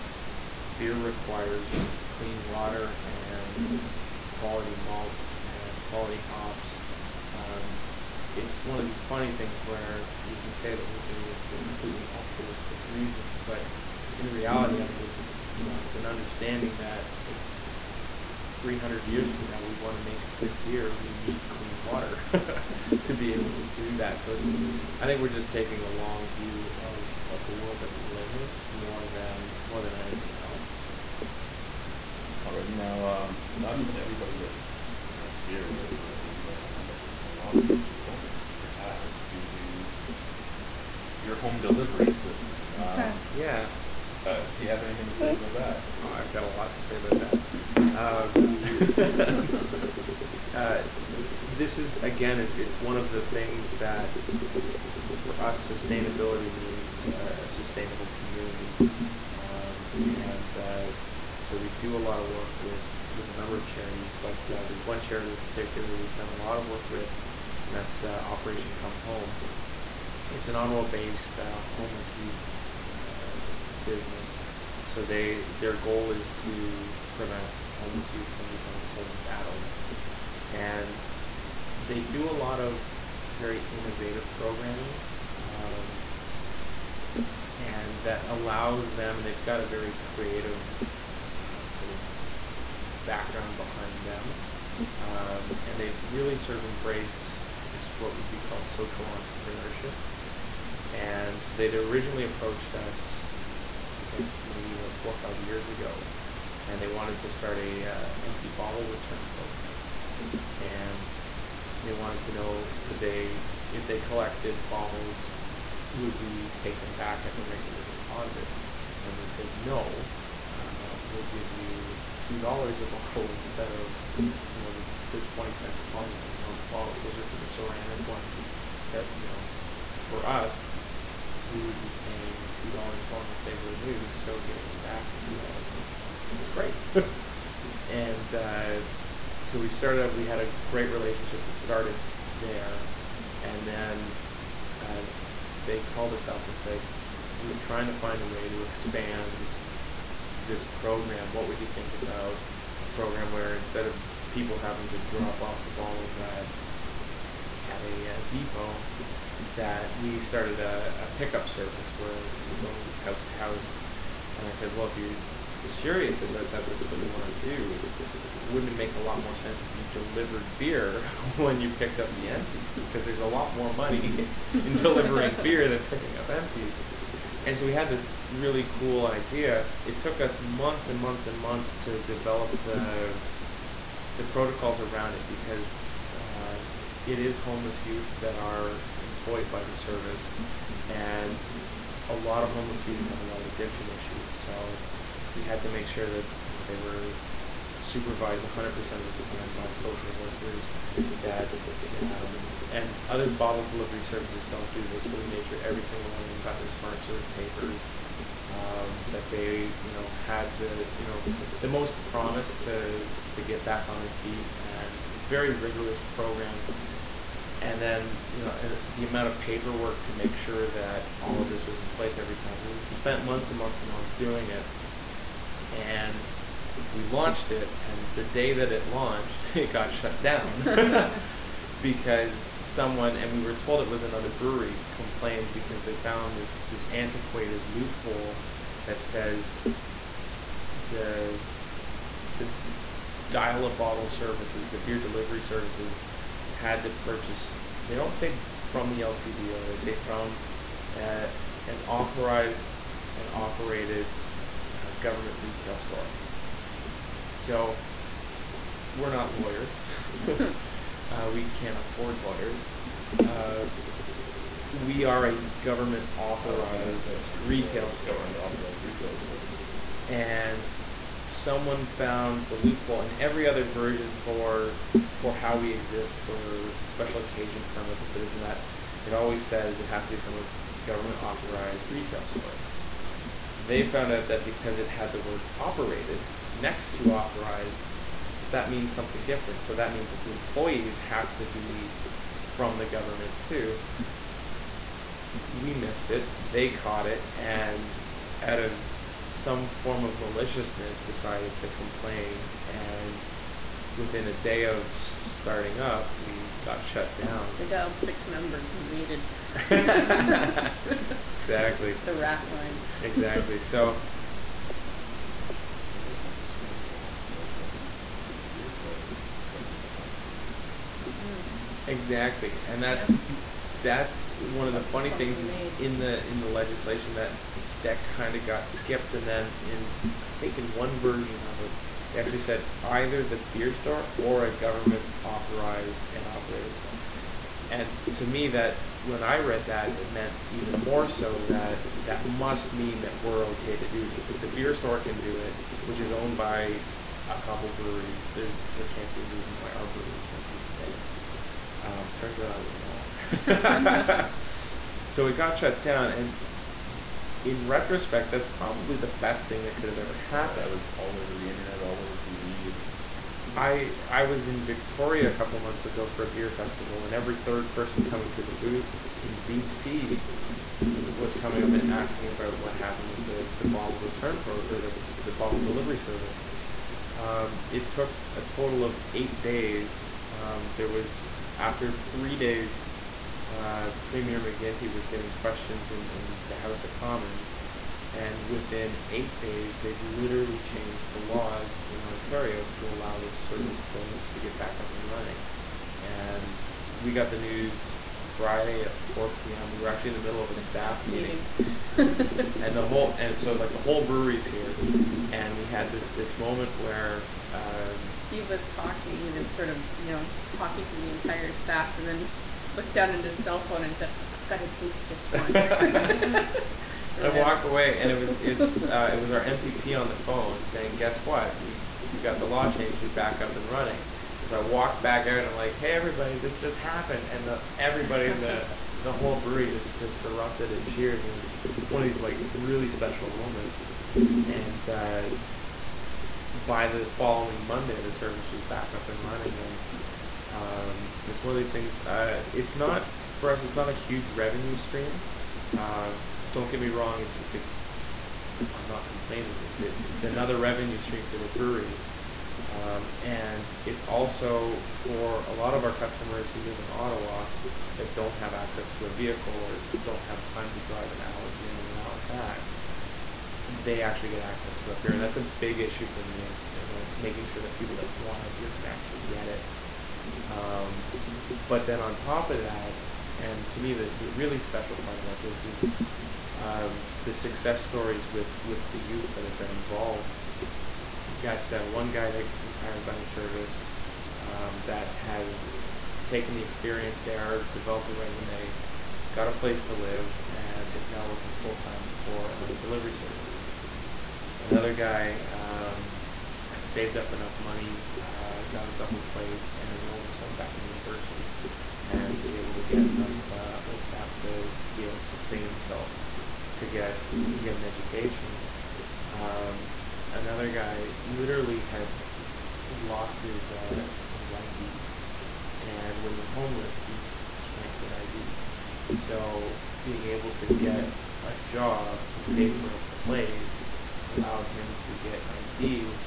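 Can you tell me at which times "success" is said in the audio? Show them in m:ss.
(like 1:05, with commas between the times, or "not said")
7:57.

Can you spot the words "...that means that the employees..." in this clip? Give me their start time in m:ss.
4:49.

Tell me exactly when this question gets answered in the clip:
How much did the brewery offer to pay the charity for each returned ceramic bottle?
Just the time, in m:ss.
2:02.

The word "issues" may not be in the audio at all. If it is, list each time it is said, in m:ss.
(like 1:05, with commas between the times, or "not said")
3:13, 7:45.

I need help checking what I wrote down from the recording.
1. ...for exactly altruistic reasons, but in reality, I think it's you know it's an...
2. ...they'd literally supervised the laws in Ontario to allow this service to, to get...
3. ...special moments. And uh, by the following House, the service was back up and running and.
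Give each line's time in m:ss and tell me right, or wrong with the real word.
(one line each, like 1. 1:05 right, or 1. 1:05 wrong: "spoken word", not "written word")
1. 0:11 wrong: "completely", not "exactly"
2. 6:29 wrong: "changed", not "supervised"
3. 7:12 wrong: "Monday", not "House".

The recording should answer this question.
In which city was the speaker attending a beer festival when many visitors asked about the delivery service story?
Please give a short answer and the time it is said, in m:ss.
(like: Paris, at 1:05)
Victoria, at 6:04.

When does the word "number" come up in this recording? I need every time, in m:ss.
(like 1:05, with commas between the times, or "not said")
1:03, 5:08.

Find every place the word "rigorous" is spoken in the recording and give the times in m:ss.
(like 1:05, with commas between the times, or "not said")
3:35.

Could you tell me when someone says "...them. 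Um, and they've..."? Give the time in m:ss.
1:34.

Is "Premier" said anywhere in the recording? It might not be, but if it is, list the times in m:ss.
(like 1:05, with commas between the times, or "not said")
6:24.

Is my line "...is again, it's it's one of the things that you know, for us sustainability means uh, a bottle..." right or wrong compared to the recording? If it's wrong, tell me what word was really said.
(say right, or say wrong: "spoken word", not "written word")
wrong: "sustainable", not "bottle".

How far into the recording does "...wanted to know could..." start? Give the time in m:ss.
1:51.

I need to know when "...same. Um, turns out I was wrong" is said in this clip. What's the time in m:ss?
5:50.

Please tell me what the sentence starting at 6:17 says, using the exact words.
Um, it took a total of eight days.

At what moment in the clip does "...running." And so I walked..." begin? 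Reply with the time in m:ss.
7:03.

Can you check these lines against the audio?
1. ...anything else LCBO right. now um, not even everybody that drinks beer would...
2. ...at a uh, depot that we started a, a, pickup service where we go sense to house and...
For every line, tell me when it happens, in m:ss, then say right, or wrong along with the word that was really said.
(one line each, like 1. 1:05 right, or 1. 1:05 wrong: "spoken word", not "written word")
1. 0:29 wrong: "All", not "LCBO"
2. 2:37 wrong: "house", not "sense".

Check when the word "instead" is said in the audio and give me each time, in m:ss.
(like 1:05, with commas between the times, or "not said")
2:03, 2:33.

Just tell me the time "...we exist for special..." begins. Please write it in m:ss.
4:35.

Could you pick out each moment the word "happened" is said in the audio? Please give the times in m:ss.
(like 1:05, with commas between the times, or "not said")
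6:00, 6:12, 7:06.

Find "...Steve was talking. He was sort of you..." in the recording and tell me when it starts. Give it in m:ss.
6:48.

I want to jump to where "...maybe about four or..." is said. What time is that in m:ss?
1:44.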